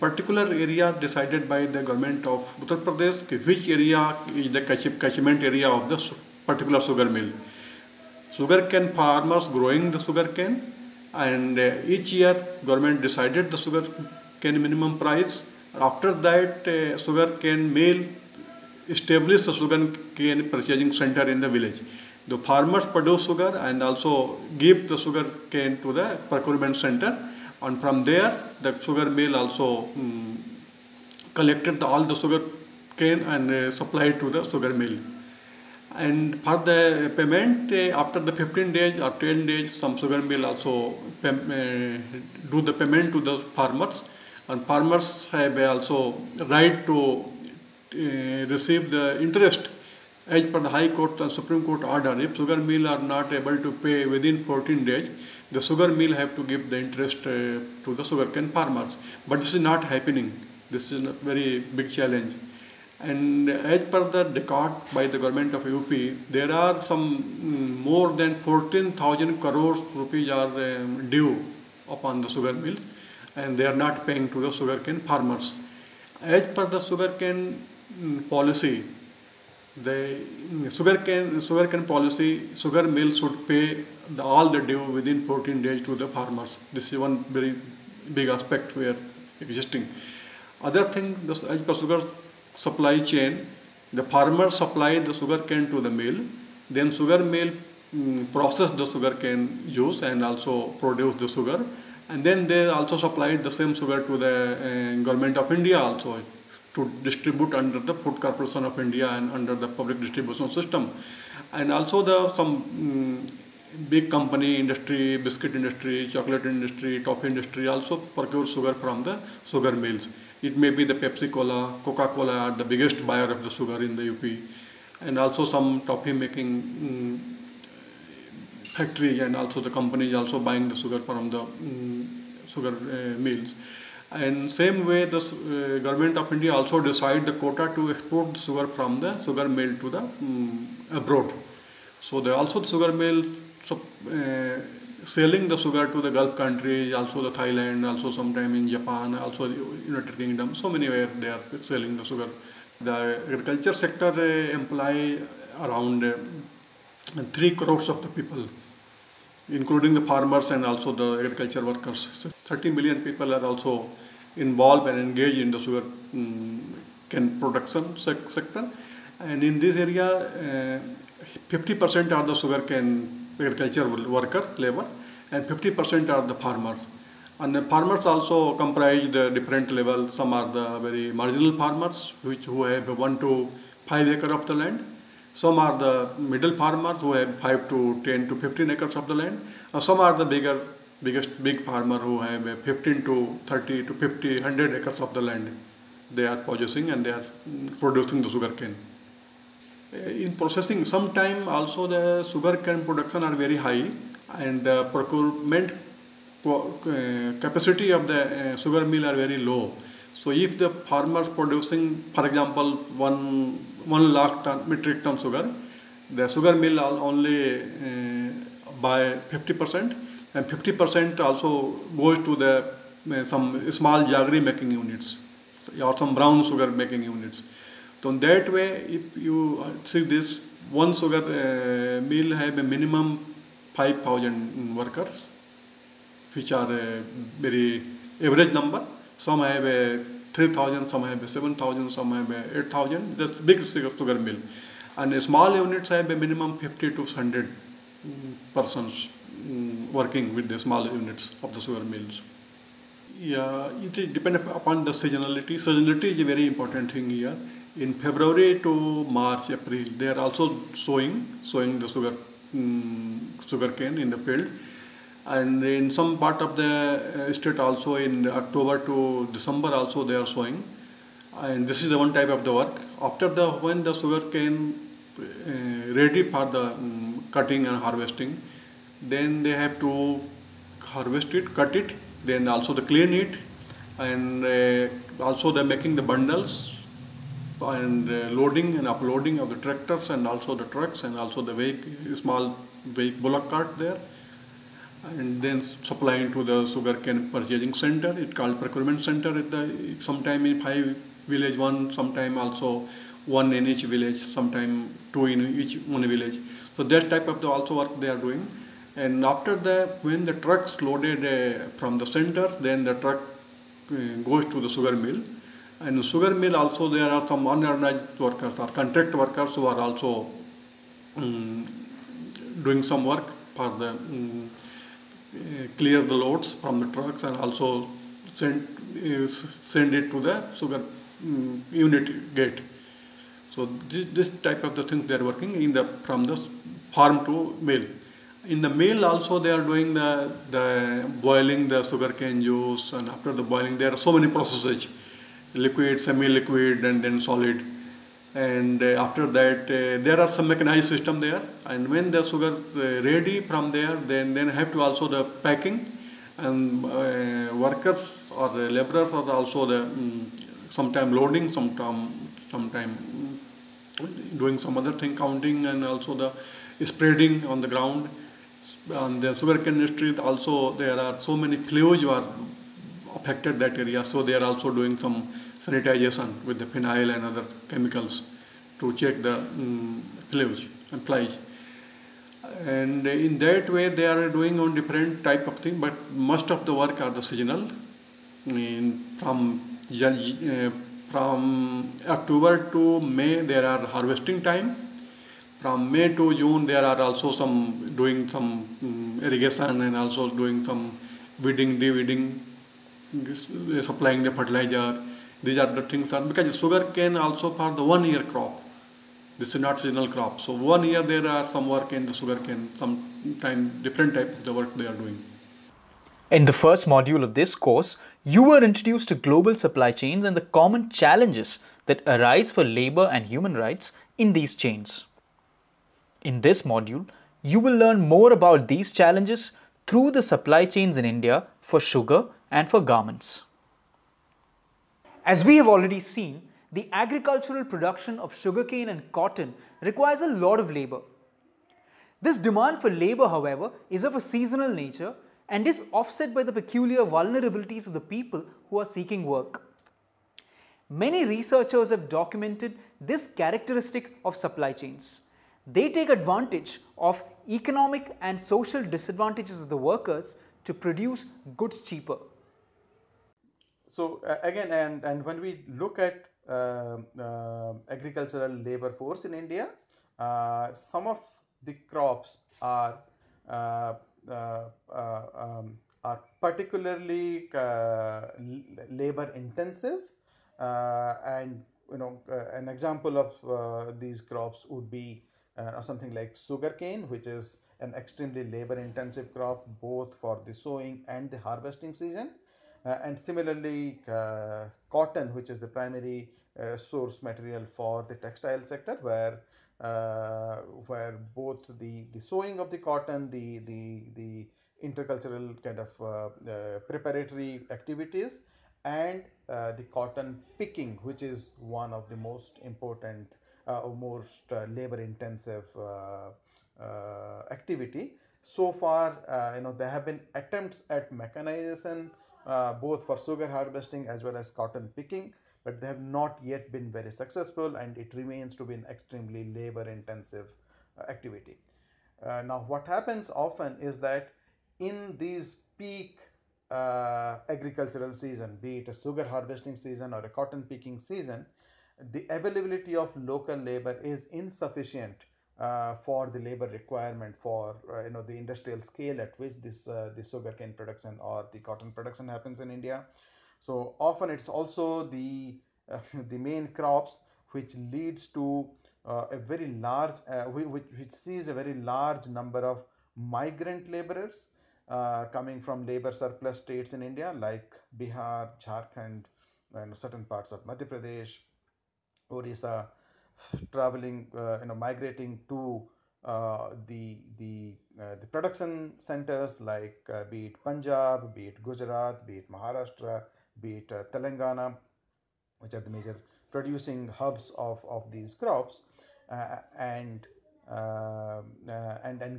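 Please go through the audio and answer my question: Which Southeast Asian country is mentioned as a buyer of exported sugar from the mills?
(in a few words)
Thailand.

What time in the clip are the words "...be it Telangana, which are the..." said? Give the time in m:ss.
9:43.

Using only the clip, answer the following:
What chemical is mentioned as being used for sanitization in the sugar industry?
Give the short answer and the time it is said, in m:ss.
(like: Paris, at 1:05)
phenyl, at 6:16.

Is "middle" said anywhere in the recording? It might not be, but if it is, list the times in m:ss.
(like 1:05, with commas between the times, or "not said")
3:06.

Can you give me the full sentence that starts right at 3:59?
Some have a 3,000, some have 7,000, some have 8,000.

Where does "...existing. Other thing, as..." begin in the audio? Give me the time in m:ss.
1:29.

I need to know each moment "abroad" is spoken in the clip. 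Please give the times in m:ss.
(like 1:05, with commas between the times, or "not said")
2:21.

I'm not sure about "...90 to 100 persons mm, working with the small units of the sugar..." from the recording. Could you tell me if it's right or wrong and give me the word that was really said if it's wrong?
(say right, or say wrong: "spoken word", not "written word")
wrong: "50", not "90".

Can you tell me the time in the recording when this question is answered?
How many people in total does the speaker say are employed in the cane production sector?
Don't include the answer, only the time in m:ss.
2:42.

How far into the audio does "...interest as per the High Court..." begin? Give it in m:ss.
0:49.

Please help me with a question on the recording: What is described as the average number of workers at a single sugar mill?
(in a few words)
5,000.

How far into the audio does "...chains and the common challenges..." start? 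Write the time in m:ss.
6:59.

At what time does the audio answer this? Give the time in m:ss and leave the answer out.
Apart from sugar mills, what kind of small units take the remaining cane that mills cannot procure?
3:44.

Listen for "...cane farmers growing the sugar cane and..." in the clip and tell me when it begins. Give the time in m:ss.
0:08.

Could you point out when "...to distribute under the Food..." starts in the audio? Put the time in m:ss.
1:46.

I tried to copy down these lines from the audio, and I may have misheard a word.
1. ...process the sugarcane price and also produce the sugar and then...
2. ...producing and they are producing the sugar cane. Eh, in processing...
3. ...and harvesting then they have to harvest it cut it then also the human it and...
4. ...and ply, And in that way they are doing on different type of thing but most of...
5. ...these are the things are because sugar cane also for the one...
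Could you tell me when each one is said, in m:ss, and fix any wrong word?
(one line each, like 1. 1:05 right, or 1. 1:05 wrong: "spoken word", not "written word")
1. 1:38 wrong: "juice", not "price"
2. 3:16 right
3. 4:37 wrong: "clean", not "human"
4. 6:20 right
5. 6:45 right.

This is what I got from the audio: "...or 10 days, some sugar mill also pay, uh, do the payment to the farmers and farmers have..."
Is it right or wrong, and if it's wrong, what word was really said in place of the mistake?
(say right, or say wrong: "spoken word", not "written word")
right.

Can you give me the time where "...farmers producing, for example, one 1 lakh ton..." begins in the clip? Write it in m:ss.
3:30.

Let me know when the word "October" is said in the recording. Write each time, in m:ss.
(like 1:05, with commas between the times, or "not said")
4:28, 6:32.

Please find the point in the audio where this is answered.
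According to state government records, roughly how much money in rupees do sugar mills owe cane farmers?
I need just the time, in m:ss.
1:08.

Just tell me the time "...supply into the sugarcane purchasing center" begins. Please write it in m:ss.
4:55.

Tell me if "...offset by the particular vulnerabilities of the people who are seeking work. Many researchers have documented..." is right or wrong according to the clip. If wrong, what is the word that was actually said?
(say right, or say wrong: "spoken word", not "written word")
wrong: "peculiar", not "particular".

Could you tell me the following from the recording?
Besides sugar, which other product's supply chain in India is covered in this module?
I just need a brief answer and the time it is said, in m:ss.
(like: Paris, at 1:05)
garments, at 7:12.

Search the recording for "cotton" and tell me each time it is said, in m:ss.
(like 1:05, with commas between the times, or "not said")
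7:19, 8:14, 8:22, 8:29, 8:44, 9:00, 9:11.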